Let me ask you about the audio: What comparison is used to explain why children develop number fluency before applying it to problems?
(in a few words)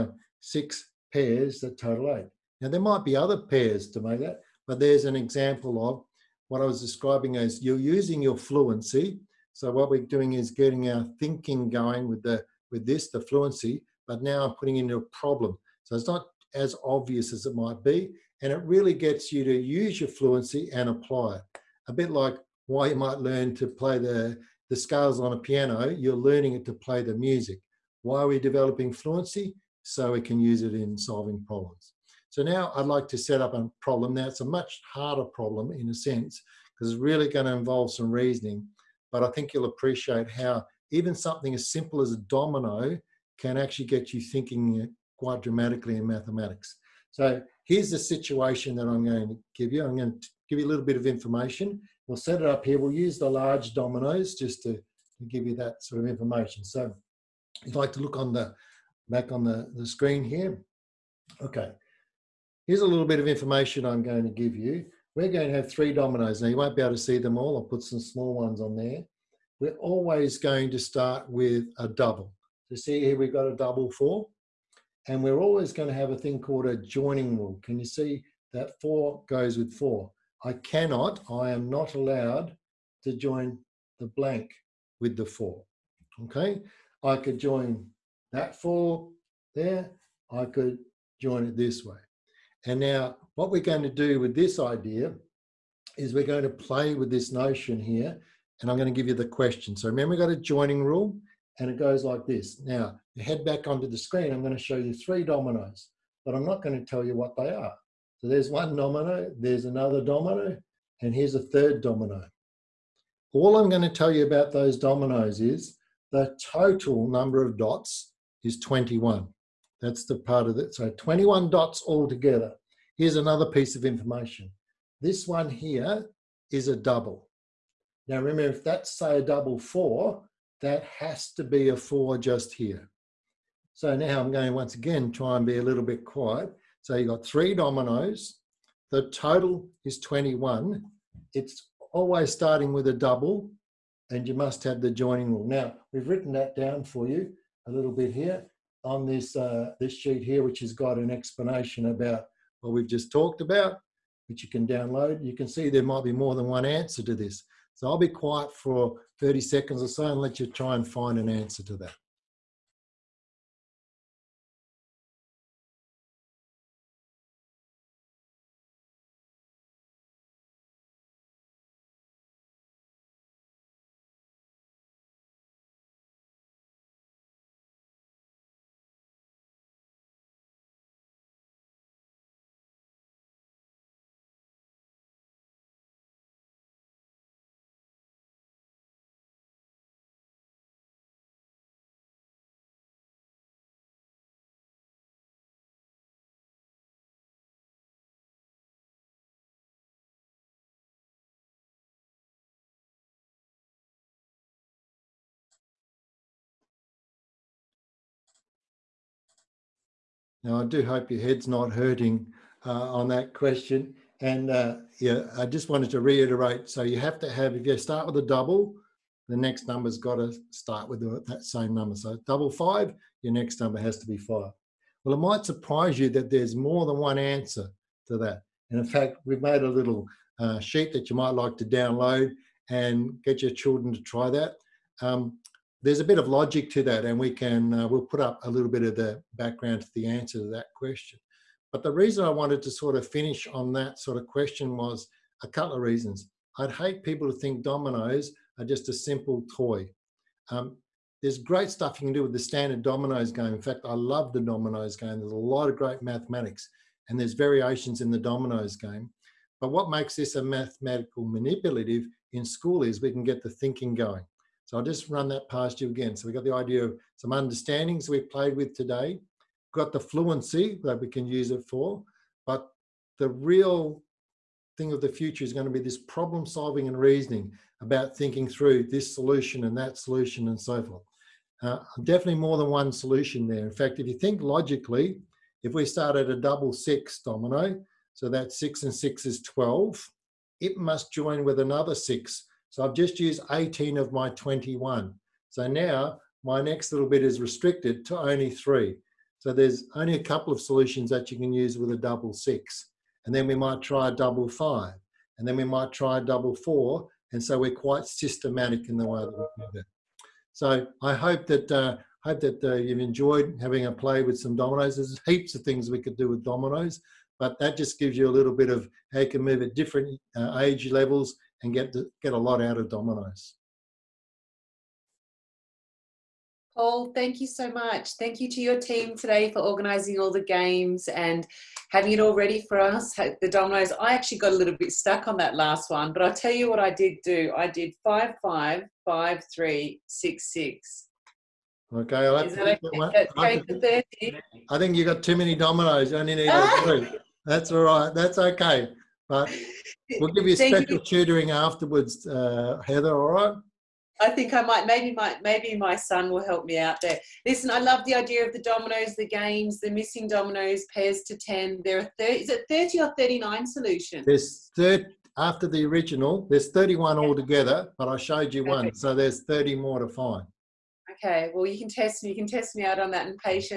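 scales on a piano.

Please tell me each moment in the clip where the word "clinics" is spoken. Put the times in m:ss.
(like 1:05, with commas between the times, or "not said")
not said.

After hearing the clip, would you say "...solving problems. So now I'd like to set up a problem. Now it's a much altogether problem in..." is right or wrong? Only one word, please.
wrong.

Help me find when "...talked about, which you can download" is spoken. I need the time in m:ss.
2:33.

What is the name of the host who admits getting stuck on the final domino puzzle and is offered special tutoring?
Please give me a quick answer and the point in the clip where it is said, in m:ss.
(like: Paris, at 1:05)
Heather, at 5:52.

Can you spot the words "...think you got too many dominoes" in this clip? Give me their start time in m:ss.
5:44.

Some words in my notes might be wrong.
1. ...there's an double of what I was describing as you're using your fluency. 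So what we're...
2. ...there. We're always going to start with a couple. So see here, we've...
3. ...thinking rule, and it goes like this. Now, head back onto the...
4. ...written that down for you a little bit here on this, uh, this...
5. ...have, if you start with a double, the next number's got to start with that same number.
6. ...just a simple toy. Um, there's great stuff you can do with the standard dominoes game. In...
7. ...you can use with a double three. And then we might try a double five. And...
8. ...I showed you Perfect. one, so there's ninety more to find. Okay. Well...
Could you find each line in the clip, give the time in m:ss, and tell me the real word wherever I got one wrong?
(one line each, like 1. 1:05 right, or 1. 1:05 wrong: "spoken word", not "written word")
1. 0:04 wrong: "example", not "double"
2. 1:08 wrong: "double", not "couple"
3. 1:40 wrong: "joining", not "thinking"
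4. 2:26 right
5. 3:37 right
6. 4:08 right
7. 5:01 wrong: "six", not "three"
8. 6:08 wrong: "thirty", not "ninety".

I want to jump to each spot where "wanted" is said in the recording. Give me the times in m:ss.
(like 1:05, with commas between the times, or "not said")
3:35, 4:02.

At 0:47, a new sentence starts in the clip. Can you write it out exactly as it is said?
So here's the situation that I'm going to give you.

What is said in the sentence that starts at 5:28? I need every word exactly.
Thank you to your team today for organising all the games and having it all ready for us.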